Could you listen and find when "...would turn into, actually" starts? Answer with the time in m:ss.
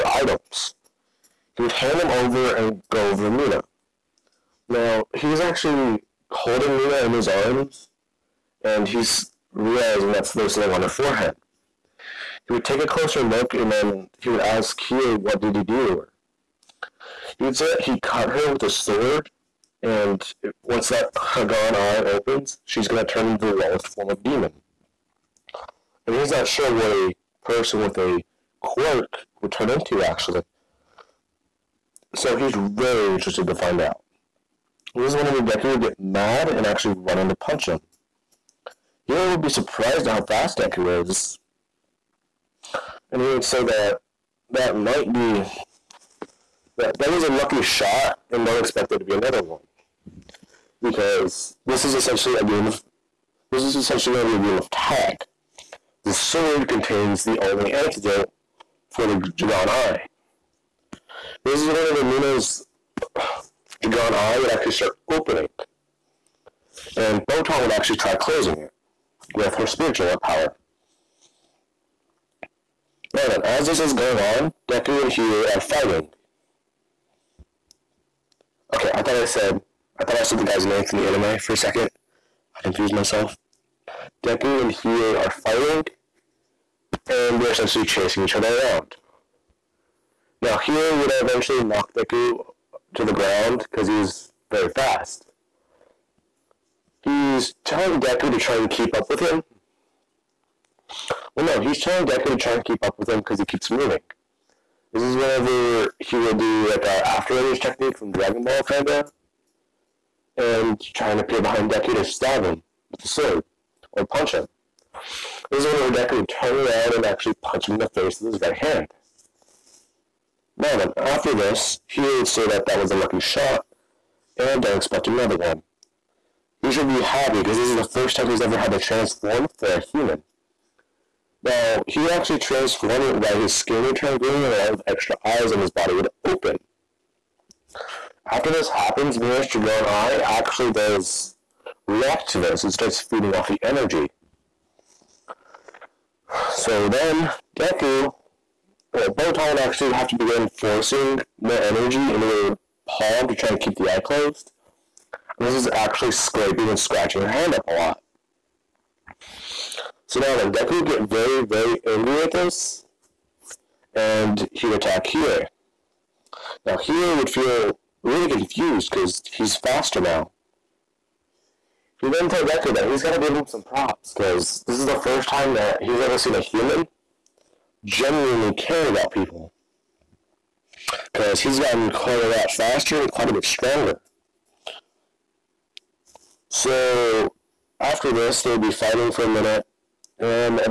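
0:29.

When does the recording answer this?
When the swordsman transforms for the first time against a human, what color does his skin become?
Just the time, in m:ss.
2:14.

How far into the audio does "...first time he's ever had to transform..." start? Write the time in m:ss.
2:07.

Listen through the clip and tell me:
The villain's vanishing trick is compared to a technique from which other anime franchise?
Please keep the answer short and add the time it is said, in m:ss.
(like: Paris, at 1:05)
Dragon Ball, at 1:48.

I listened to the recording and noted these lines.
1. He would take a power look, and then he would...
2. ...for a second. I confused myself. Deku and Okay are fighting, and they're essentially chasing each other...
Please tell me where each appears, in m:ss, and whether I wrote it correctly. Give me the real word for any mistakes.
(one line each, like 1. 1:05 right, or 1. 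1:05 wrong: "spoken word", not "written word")
1. 0:12 wrong: "closer", not "power"
2. 1:21 wrong: "Hiei", not "Okay".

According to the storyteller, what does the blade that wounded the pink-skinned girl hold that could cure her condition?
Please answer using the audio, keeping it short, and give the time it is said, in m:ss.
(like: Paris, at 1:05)
The only antidote, at 0:57.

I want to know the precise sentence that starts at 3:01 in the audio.
Because he's gotten quite a lot faster and quite a bit stronger.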